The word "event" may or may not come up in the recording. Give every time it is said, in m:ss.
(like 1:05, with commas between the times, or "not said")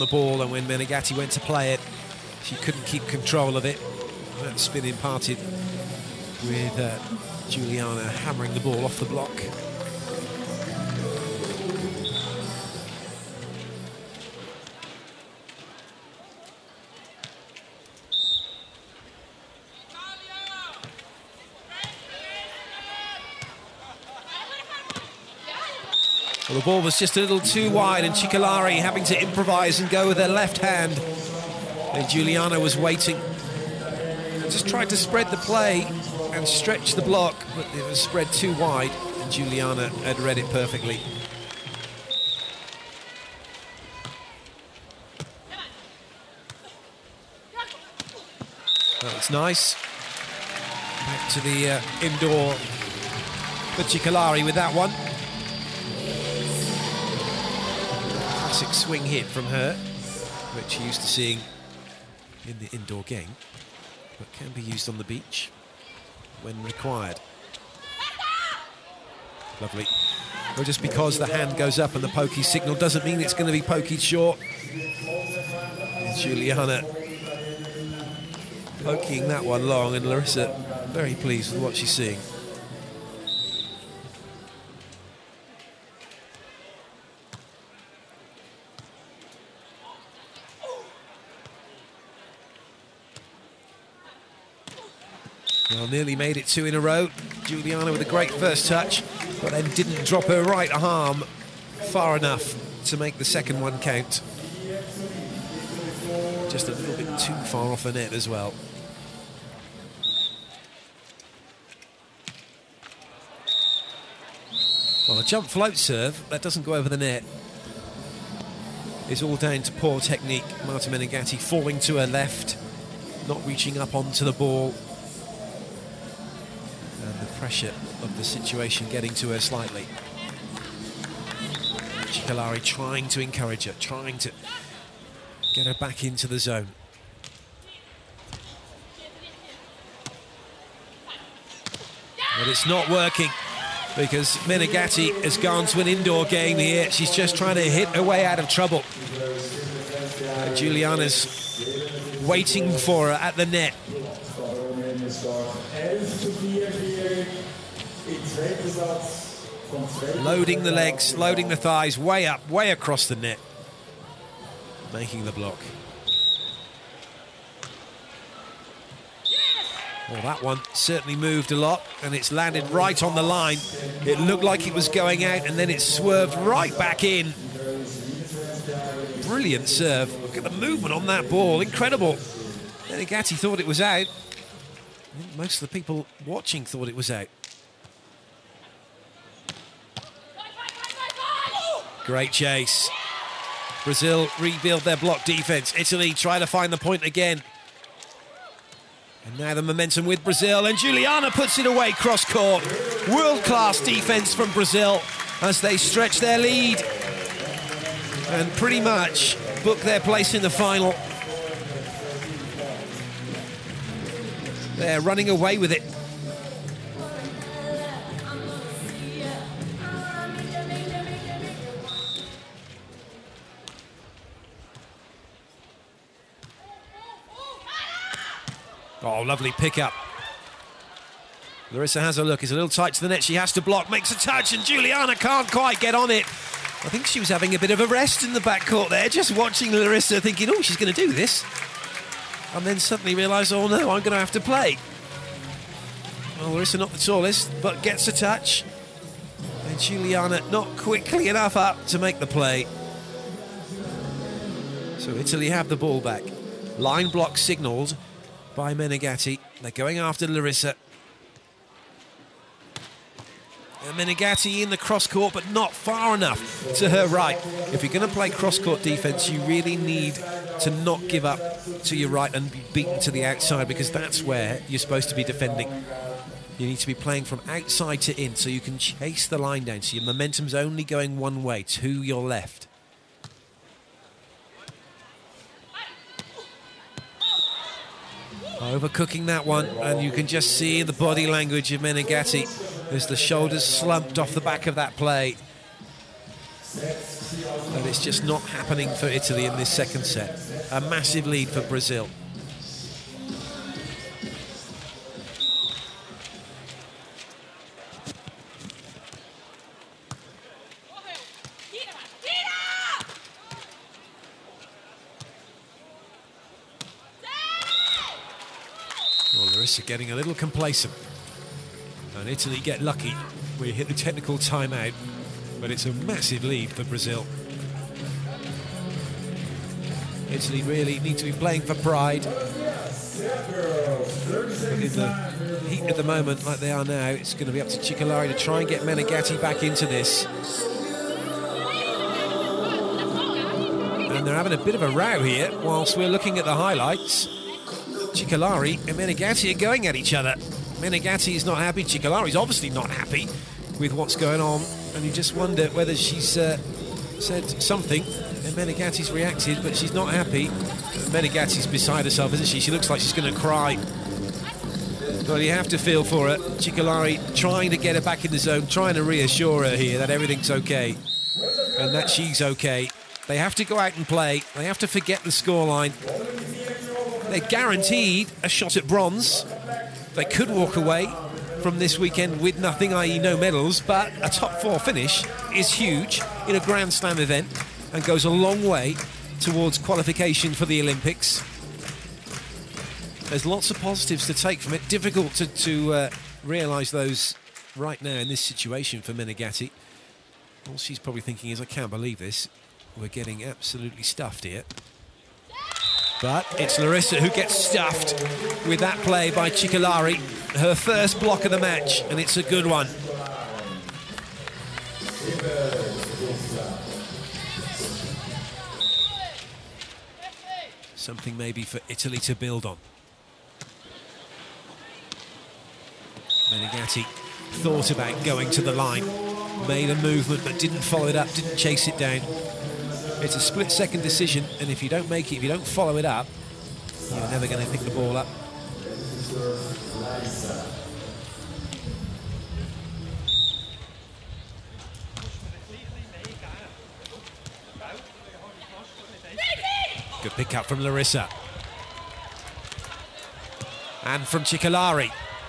6:27.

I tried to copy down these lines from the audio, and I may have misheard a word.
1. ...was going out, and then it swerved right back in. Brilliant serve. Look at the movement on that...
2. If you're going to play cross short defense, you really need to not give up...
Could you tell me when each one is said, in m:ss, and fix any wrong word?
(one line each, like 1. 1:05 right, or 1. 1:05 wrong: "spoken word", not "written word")
1. 2:54 right
2. 4:27 wrong: "court", not "short".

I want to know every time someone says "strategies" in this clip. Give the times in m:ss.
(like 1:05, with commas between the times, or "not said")
not said.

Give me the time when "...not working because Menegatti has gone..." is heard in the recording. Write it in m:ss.
2:22.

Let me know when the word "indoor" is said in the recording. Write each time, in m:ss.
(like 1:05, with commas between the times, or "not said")
0:52, 1:02, 2:25.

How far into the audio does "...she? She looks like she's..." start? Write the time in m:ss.
6:02.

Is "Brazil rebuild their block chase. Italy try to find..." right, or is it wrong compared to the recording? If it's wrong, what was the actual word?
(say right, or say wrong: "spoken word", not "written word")
wrong: "defense", not "chase".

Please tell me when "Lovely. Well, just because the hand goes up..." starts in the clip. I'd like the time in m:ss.
1:09.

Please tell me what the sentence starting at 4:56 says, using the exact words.
And it's just not happening for Italy in this second set.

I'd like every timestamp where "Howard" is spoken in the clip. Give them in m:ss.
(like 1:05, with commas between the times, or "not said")
not said.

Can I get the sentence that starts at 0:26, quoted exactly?
the ball was just a little too wide, and Cicolari having to improvise and go with their left hand.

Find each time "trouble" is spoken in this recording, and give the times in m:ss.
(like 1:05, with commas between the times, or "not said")
2:28.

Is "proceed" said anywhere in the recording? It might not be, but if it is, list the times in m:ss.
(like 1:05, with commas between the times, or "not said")
not said.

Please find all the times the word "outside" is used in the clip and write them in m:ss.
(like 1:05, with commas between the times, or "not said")
4:33, 4:37.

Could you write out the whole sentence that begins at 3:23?
World class defense from Brazil as they stretch their lead and pretty much book their place in the final.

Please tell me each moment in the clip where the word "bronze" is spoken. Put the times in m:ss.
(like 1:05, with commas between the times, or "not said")
6:18.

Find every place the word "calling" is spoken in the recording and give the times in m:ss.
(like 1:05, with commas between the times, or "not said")
not said.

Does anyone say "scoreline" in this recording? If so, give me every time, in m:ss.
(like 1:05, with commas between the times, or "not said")
6:15.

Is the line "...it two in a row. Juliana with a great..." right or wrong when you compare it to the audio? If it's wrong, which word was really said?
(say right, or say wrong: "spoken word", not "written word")
right.